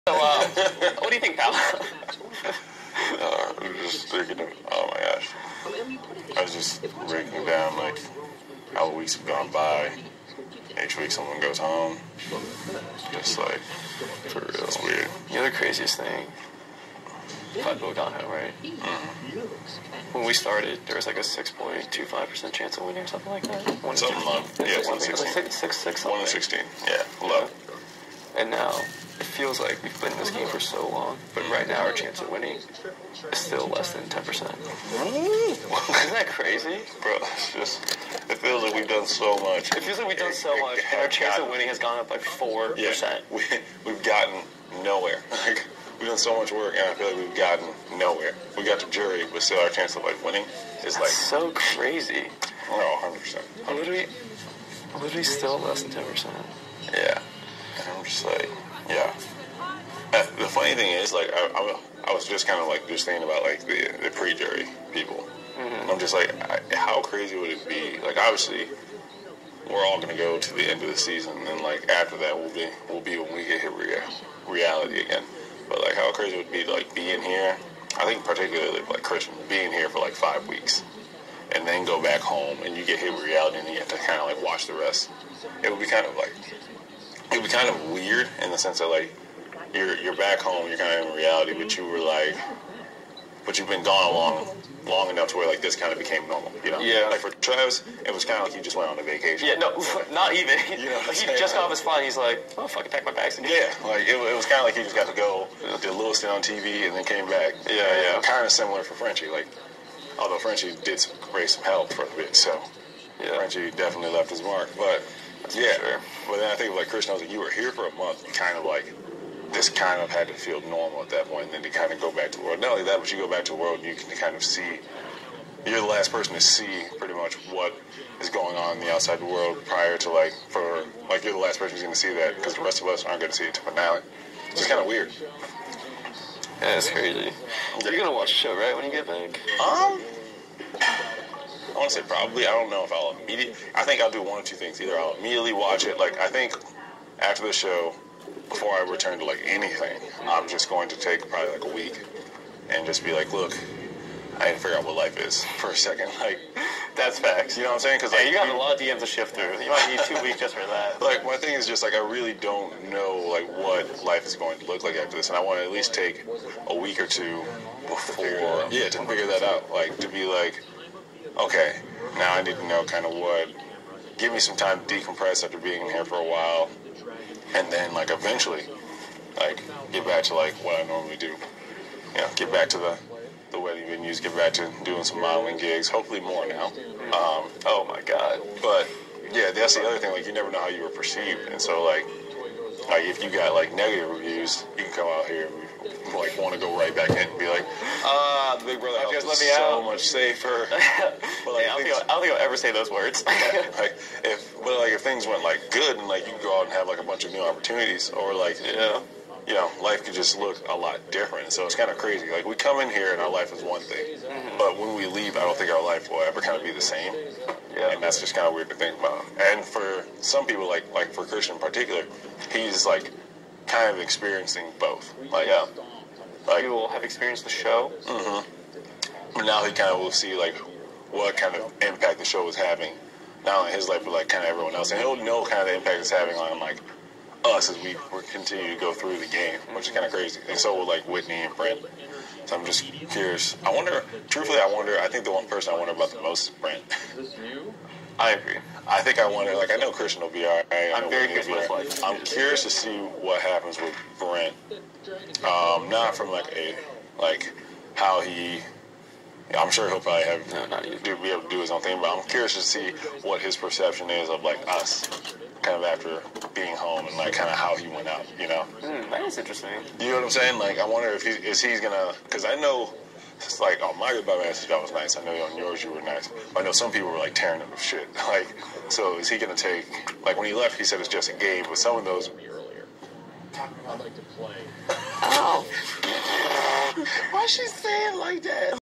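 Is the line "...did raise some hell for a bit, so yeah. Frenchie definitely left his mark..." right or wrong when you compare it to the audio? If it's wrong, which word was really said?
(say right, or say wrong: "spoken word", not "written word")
right.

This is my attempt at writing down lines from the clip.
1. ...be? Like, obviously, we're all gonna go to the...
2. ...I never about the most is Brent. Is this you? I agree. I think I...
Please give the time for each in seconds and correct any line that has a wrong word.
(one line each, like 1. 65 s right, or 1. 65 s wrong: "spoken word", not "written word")
1. 67 s right
2. 245 s wrong: "wonder", not "never".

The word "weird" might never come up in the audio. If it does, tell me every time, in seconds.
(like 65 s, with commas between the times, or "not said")
14 s, 87 s, 134 s, 218 s.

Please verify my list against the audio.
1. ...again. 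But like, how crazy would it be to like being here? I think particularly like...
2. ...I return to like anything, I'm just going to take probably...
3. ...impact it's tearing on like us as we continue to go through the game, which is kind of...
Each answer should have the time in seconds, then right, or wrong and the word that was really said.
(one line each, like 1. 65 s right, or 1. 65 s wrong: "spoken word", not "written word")
1. 74 s right
2. 148 s right
3. 235 s wrong: "having", not "tearing".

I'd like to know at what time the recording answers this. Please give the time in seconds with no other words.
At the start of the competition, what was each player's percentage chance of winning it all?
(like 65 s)
21 s.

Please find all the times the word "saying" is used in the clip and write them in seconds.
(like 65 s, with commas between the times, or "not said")
157 s, 270 s, 287 s.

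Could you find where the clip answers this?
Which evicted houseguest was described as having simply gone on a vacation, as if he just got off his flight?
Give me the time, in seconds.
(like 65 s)
97 s.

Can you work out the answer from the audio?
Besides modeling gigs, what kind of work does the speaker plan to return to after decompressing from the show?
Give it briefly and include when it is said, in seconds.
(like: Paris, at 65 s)
wedding venues, at 183 s.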